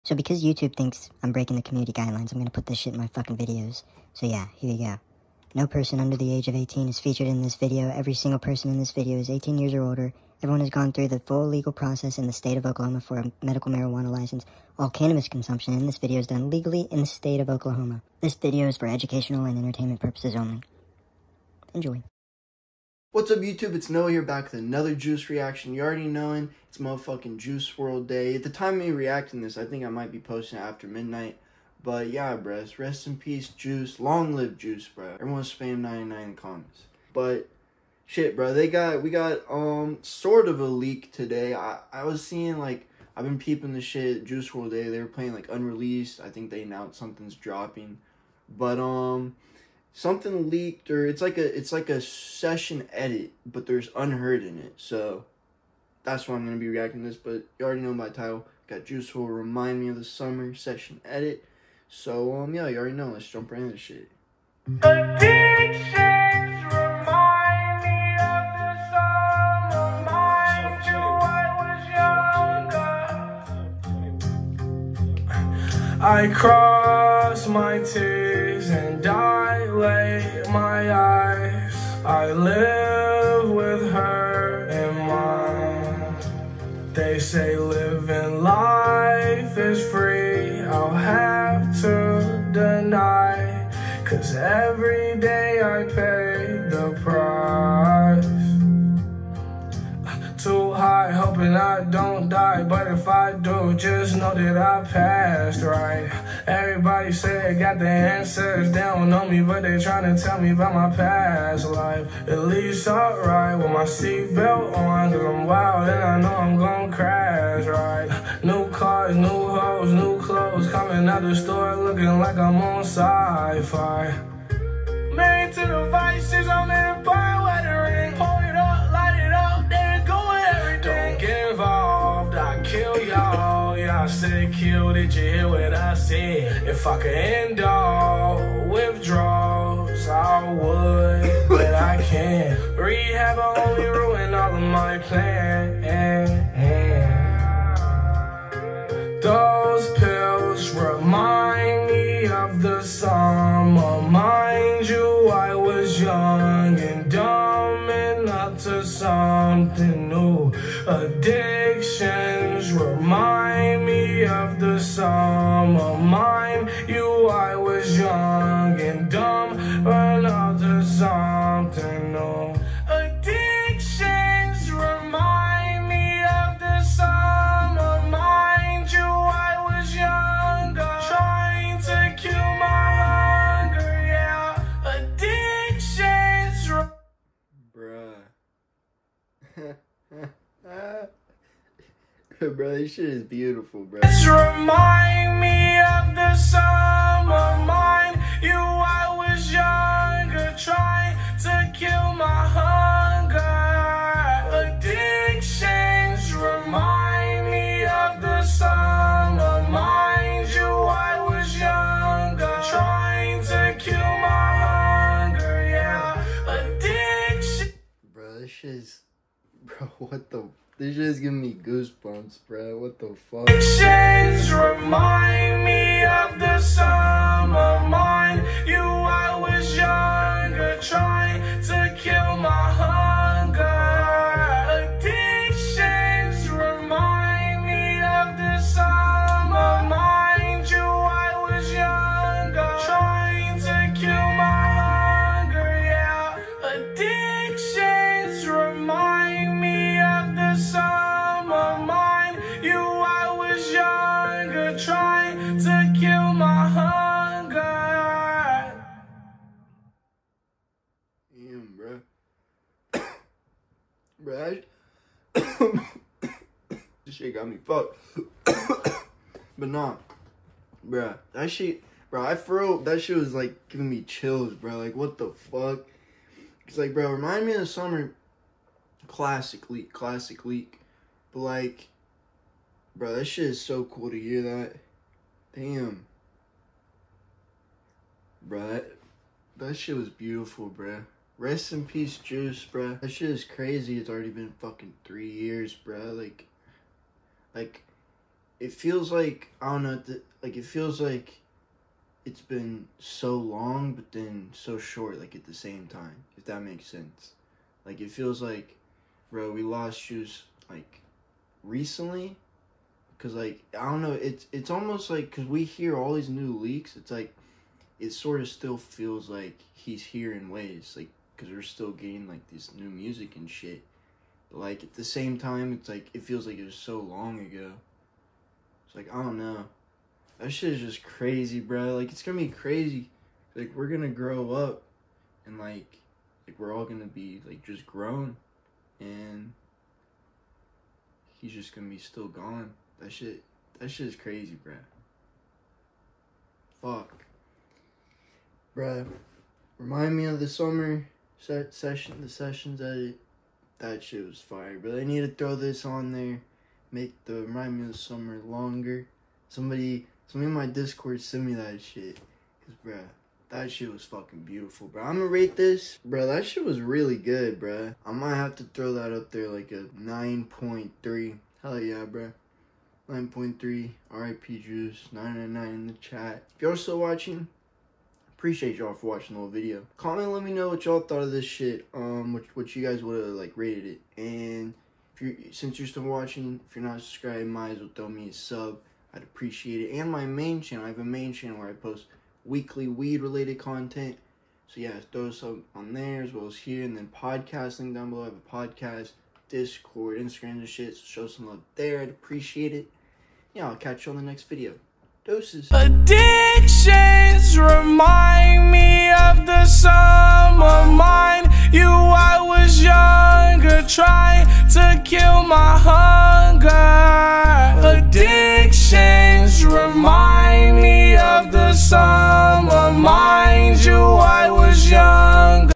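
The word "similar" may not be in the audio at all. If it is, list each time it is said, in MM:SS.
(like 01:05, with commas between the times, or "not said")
not said.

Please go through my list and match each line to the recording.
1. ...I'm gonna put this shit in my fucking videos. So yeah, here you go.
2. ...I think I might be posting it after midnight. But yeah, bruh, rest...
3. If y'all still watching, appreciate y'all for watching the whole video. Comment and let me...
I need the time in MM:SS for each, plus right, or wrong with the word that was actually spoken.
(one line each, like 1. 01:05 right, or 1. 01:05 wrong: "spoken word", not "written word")
1. 00:02 right
2. 00:29 right
3. 06:16 right.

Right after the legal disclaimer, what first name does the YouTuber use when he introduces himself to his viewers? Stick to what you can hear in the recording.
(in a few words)
Noah.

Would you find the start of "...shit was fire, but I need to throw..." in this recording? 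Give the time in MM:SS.
05:54.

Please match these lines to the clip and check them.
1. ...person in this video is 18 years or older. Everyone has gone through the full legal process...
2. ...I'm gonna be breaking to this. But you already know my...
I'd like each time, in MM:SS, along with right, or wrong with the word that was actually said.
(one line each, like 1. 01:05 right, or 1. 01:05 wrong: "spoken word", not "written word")
1. 00:08 right
2. 00:56 wrong: "reacting", not "breaking".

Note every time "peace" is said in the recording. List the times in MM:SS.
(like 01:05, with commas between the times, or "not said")
00:33, 04:51.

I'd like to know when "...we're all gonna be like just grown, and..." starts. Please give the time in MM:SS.
05:36.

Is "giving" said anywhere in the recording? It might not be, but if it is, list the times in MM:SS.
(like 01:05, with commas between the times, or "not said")
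03:41, 04:33.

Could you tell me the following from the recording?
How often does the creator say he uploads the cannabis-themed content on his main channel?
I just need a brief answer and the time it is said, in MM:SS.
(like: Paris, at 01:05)
Weekly, at 06:32.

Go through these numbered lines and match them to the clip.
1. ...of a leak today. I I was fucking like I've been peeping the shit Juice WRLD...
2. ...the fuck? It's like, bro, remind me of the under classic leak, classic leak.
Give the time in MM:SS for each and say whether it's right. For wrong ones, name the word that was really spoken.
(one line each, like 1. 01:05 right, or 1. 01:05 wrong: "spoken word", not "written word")
1. 00:40 wrong: "seeing", not "fucking"
2. 04:35 wrong: "summer", not "under".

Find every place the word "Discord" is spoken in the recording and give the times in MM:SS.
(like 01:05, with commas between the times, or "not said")
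06:00, 06:39.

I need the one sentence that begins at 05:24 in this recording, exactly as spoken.
But like at the same time, it's like it feels like it was so long ago.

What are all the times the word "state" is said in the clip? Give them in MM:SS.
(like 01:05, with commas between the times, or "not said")
00:12, 00:17.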